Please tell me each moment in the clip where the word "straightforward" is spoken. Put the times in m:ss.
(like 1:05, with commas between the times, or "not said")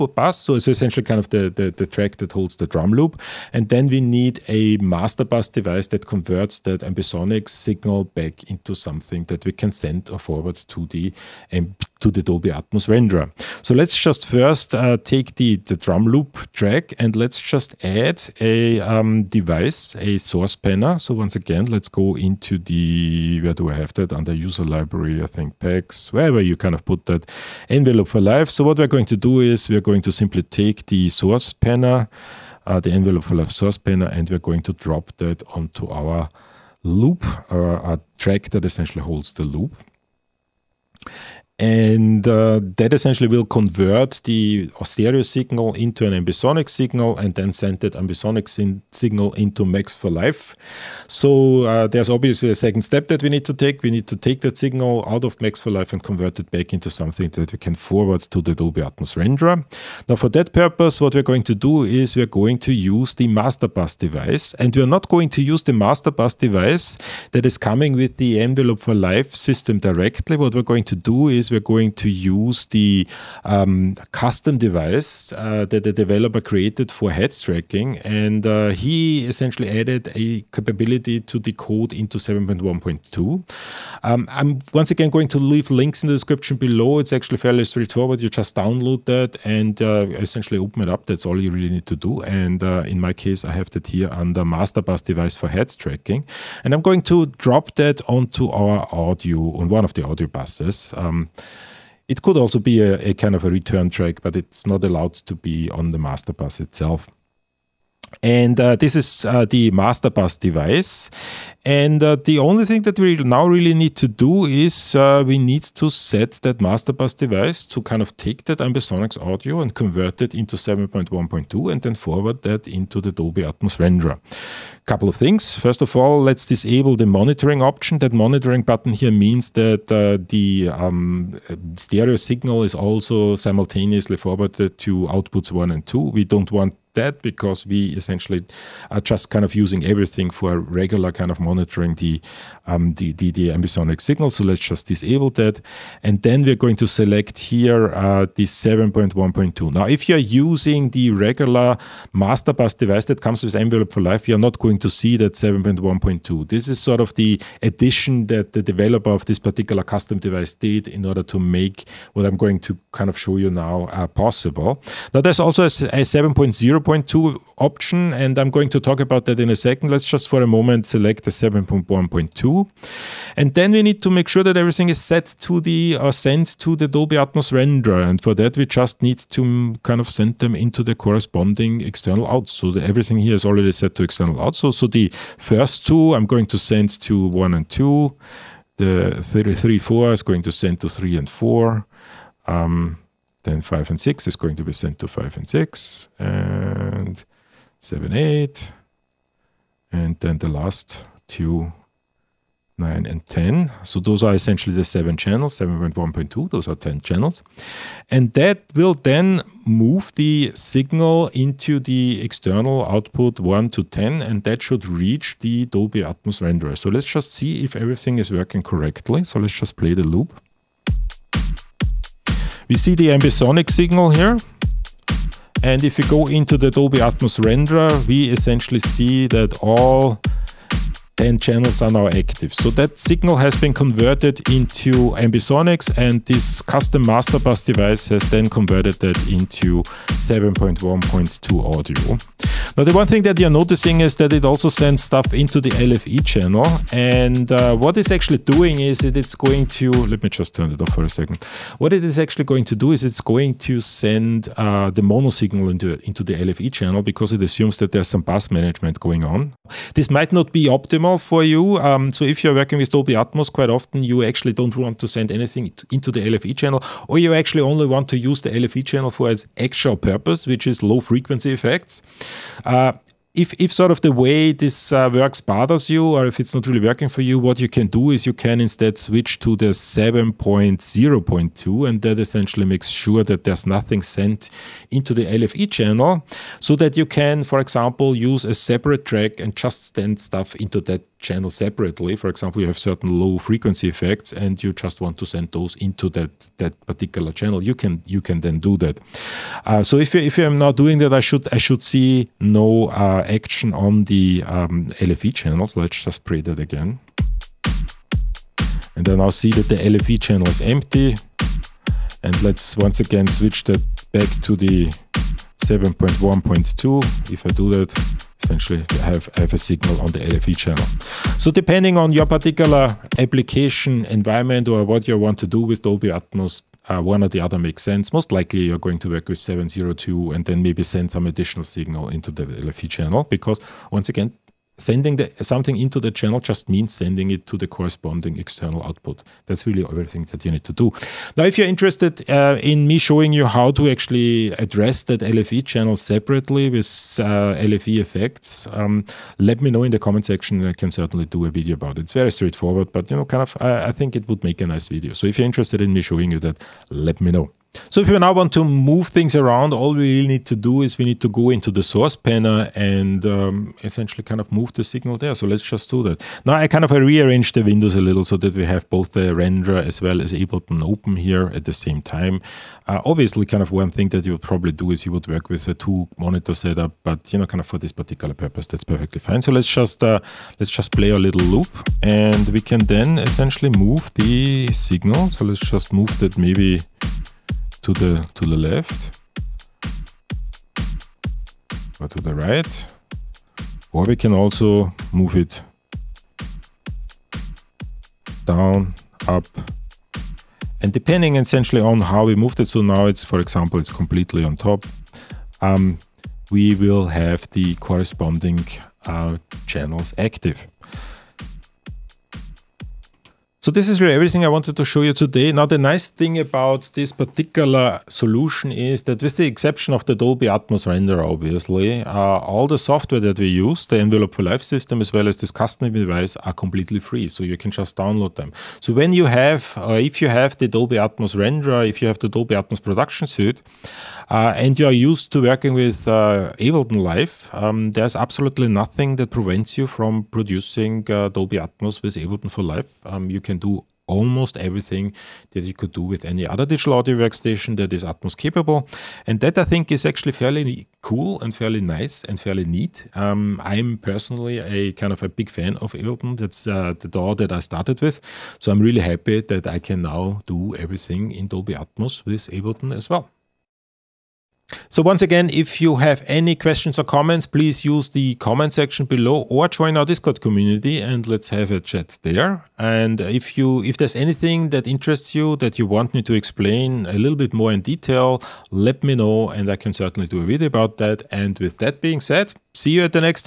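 1:27, 5:52.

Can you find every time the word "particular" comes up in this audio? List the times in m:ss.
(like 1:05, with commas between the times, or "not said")
2:39, 4:56, 5:22, 6:17, 6:57.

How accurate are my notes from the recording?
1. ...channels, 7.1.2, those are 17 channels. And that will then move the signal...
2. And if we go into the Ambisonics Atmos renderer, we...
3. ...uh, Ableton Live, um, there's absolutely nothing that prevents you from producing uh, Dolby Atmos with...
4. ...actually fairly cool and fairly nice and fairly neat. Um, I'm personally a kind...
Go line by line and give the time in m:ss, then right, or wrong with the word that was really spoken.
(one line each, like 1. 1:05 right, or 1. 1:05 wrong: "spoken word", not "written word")
1. 3:25 wrong: "10", not "17"
2. 3:45 wrong: "Dolby", not "Ambisonics"
3. 7:16 right
4. 7:30 right.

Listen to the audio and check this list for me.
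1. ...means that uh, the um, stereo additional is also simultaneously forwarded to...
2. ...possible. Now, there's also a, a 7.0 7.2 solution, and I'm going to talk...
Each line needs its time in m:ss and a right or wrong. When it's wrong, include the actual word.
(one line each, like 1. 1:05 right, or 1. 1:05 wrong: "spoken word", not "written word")
1. 2:09 wrong: "signal", not "additional"
2. 2:44 wrong: "option", not "solution".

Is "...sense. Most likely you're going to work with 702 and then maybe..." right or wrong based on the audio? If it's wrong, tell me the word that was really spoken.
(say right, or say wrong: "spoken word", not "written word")
right.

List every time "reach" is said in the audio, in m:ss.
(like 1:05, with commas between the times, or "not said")
3:34.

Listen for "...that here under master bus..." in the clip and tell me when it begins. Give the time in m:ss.
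1:33.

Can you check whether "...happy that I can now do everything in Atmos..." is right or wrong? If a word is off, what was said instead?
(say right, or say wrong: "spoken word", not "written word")
wrong: "Dolby", not "Atmos".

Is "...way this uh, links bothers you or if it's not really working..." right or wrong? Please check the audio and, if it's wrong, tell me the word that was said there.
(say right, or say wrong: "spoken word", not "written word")
wrong: "works", not "links".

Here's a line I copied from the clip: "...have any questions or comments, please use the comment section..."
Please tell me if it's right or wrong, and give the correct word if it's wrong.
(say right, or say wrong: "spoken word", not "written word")
right.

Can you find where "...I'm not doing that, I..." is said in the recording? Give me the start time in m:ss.
5:00.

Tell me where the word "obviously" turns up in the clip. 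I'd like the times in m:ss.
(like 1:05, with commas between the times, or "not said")
0:52, 6:13, 7:01.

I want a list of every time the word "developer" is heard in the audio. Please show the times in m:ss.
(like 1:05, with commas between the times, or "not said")
1:15, 2:38.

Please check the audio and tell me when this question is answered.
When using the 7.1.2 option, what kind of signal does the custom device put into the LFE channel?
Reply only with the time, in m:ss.
4:15.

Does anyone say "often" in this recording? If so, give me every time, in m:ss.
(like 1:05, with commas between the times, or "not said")
4:23.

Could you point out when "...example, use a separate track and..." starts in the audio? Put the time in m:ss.
4:47.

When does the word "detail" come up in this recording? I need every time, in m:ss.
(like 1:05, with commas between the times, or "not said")
7:57.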